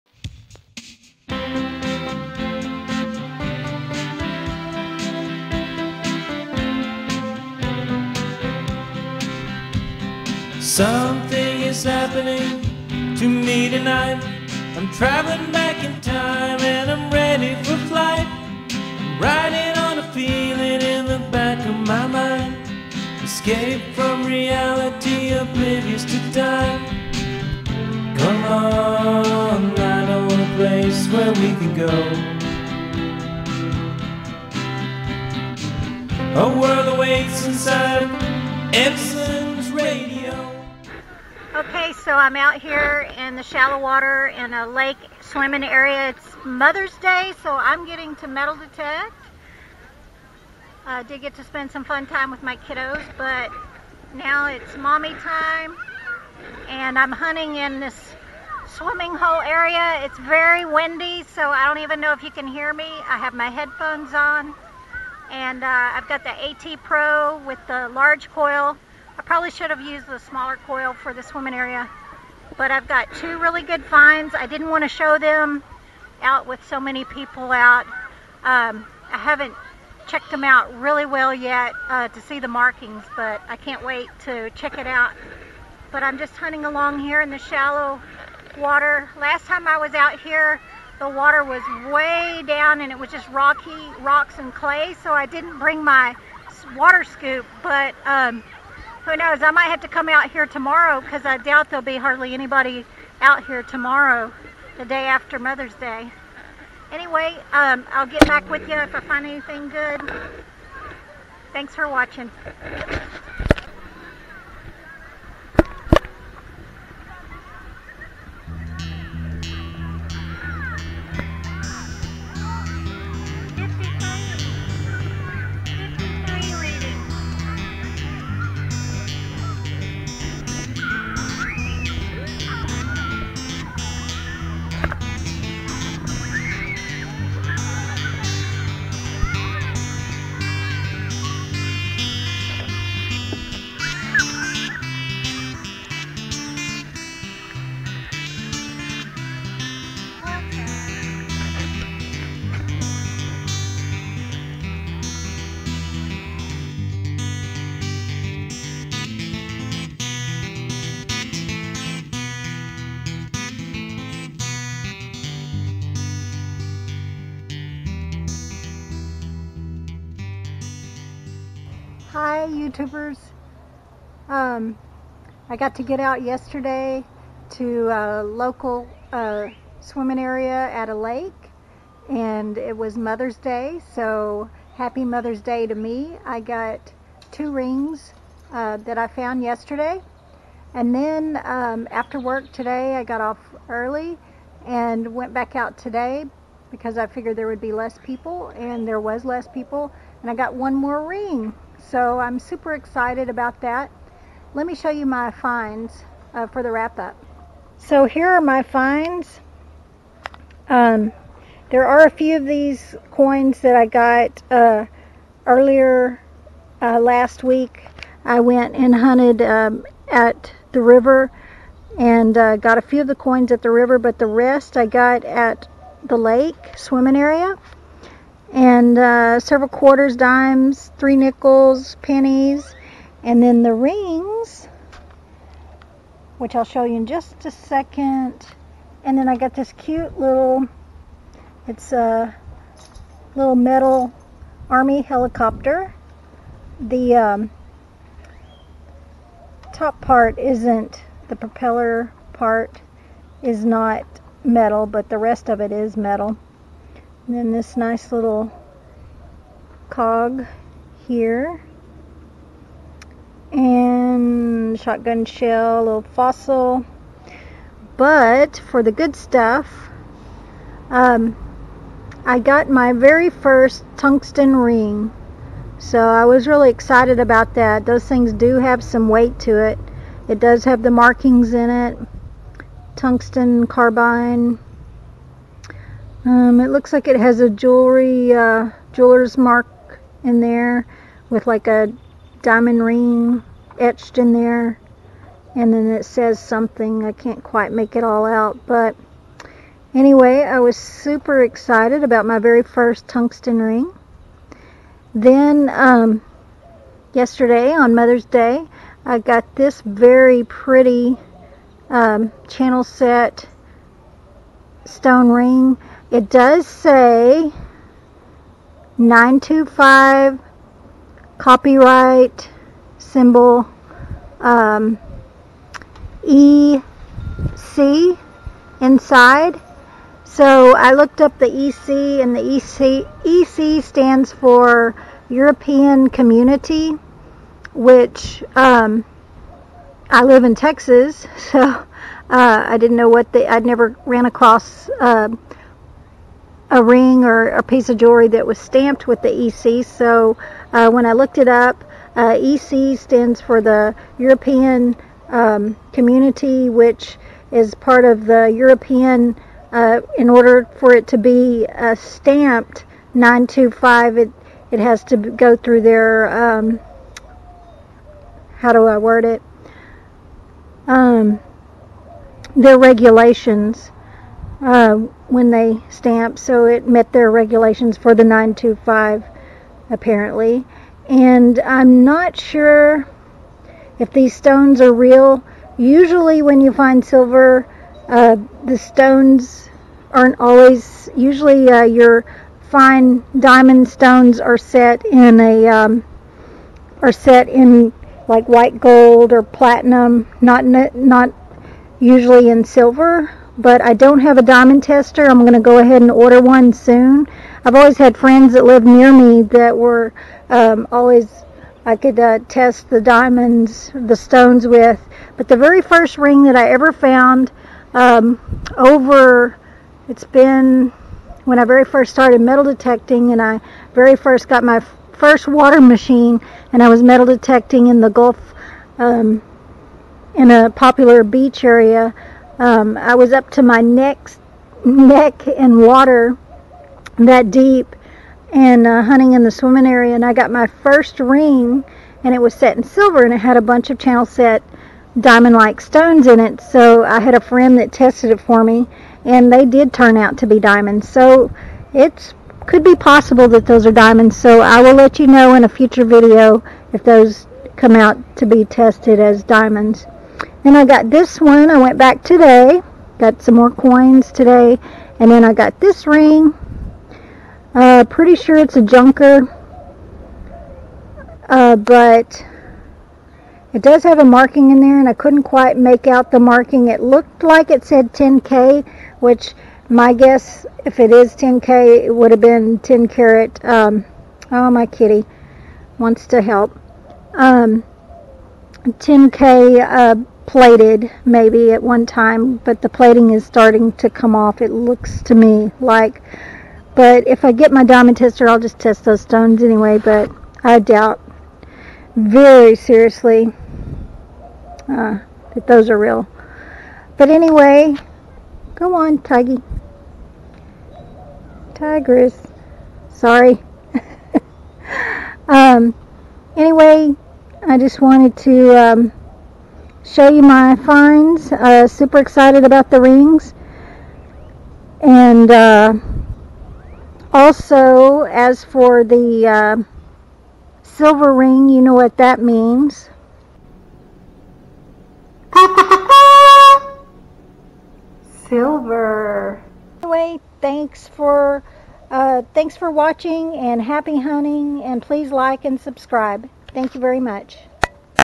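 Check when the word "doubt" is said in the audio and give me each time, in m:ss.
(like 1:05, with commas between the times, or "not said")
1:41, 8:20.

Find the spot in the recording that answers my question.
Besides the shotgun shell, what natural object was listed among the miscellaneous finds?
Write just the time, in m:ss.
4:26.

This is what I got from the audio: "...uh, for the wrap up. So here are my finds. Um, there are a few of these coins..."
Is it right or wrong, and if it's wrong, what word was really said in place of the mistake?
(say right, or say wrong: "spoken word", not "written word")
right.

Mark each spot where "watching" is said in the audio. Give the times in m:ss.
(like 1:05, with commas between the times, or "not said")
1:51, 9:02.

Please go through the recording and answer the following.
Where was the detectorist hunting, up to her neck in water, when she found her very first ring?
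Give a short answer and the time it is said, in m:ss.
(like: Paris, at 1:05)
the Gulf, at 7:08.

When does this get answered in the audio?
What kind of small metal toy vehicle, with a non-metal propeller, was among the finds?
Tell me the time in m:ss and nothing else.
4:04.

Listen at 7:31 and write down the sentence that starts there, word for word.
So it's could be possible that those are diamonds.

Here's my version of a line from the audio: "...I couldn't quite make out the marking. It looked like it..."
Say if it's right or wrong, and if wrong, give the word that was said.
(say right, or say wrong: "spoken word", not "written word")
right.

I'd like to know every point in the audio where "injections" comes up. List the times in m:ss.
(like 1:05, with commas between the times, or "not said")
not said.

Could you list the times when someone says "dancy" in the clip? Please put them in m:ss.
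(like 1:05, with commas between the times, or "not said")
not said.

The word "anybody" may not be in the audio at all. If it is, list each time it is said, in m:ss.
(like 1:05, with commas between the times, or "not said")
1:42.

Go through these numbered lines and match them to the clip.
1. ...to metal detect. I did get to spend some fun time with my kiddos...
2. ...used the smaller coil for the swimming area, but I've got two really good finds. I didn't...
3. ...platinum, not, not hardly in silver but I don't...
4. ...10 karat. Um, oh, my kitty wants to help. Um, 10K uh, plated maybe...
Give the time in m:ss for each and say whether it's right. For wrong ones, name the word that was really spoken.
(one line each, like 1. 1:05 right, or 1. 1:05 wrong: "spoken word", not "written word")
1. 0:48 right
2. 1:09 right
3. 6:39 wrong: "usually", not "hardly"
4. 8:02 right.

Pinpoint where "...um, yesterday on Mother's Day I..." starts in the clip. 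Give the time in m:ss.
5:05.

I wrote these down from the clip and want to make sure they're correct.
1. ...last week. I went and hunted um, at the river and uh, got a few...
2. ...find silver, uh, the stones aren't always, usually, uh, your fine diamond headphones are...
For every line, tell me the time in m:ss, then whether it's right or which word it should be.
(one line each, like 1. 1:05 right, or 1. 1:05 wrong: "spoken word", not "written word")
1. 3:36 right
2. 6:26 wrong: "stones", not "headphones".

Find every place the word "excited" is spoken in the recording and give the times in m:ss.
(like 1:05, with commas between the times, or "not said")
3:22, 4:36, 5:01, 8:42.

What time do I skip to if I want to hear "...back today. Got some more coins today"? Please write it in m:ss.
7:41.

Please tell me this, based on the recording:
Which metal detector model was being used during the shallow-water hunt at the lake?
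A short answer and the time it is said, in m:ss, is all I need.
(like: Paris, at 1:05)
AT Pro, at 1:06.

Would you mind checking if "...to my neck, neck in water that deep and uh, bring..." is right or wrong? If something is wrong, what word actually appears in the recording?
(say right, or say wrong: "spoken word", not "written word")
wrong: "hunting", not "bring".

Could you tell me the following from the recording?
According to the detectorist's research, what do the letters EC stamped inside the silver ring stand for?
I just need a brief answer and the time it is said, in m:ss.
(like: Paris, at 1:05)
European Community, at 5:35.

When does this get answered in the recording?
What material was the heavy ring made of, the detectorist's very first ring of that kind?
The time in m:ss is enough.
4:42.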